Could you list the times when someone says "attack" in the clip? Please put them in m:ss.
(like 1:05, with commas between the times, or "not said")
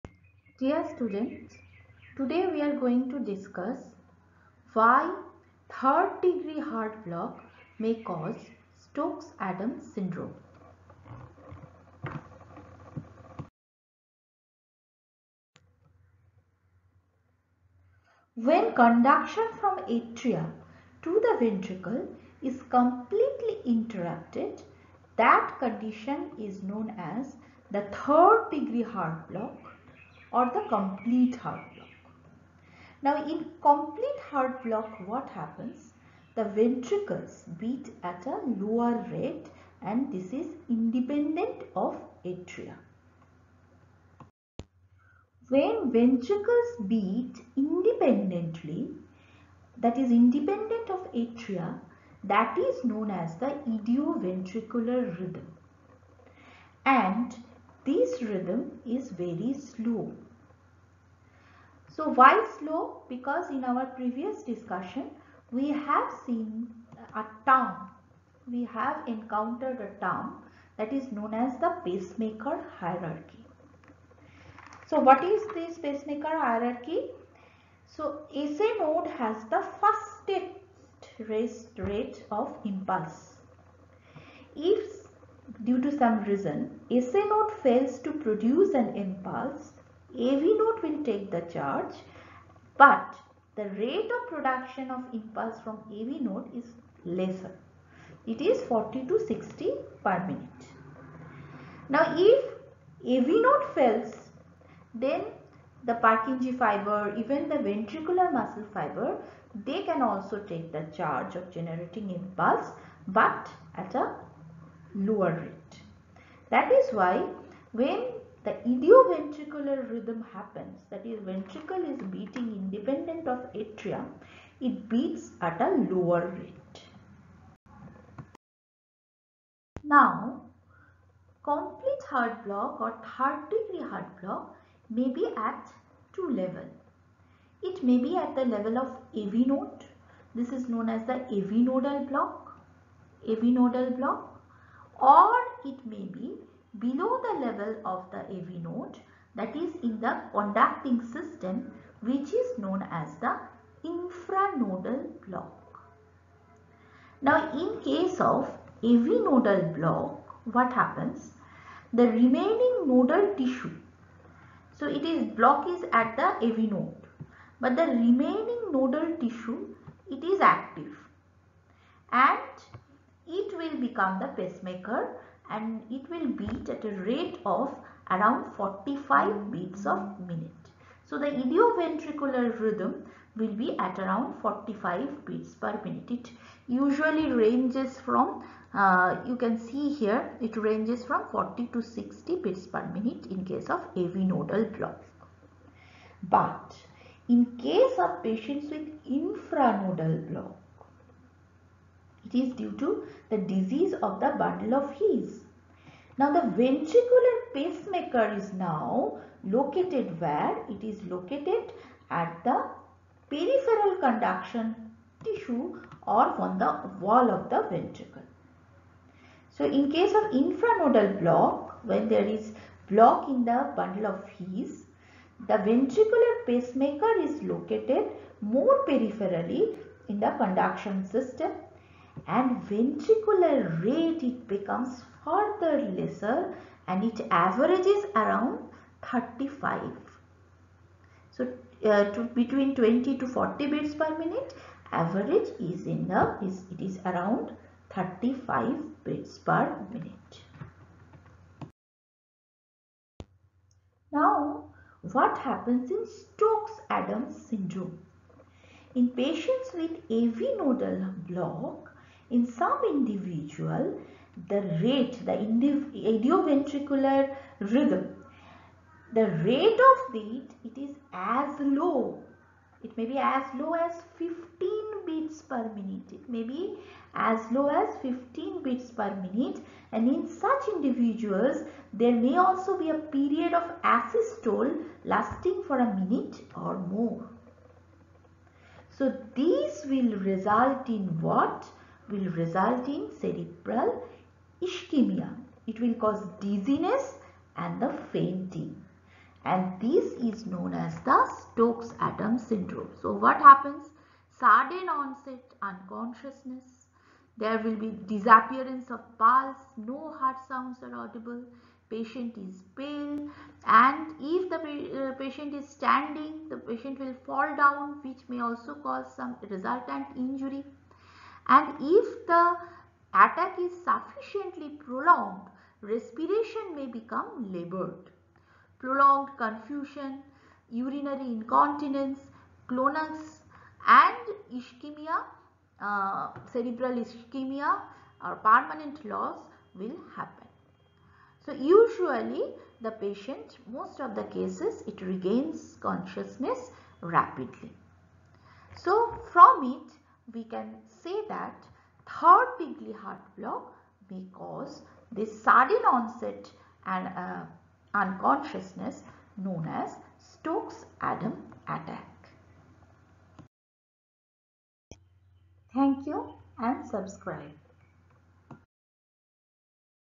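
5:23, 6:01.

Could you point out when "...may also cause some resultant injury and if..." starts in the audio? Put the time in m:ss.
5:18.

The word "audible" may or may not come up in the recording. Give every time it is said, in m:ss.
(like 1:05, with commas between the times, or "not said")
5:10.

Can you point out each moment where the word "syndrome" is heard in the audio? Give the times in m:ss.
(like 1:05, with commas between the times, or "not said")
0:09, 4:17, 5:02.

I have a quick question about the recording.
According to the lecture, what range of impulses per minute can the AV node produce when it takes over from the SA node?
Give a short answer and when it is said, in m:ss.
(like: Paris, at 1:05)
40 to 60 per minute, at 1:38.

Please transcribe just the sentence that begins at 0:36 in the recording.
The ventricles beat at a lower rate and this is independent of atria.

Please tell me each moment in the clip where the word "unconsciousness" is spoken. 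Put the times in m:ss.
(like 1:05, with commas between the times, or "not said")
5:05, 5:57.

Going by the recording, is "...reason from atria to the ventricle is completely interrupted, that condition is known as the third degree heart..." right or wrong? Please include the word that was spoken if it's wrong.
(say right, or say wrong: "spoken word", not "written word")
wrong: "conduction", not "reason".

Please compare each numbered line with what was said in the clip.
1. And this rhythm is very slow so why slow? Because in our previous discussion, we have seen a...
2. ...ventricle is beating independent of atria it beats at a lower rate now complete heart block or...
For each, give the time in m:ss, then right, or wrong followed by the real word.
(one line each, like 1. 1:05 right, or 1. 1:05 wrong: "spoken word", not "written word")
1. 0:56 right
2. 2:01 right.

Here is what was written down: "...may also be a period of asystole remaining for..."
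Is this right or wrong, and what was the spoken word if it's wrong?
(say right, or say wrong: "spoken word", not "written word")
wrong: "lasting", not "remaining".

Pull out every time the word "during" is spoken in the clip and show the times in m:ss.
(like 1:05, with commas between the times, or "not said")
not said.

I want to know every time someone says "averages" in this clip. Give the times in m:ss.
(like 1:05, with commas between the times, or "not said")
3:57, 4:04.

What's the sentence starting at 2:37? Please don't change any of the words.
Now in case of AV nodal block what happens?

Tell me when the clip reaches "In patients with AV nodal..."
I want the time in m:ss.
4:18.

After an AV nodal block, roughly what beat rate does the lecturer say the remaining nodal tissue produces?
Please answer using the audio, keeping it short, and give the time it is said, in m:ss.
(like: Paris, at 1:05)
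45 beats per minute, at 2:58.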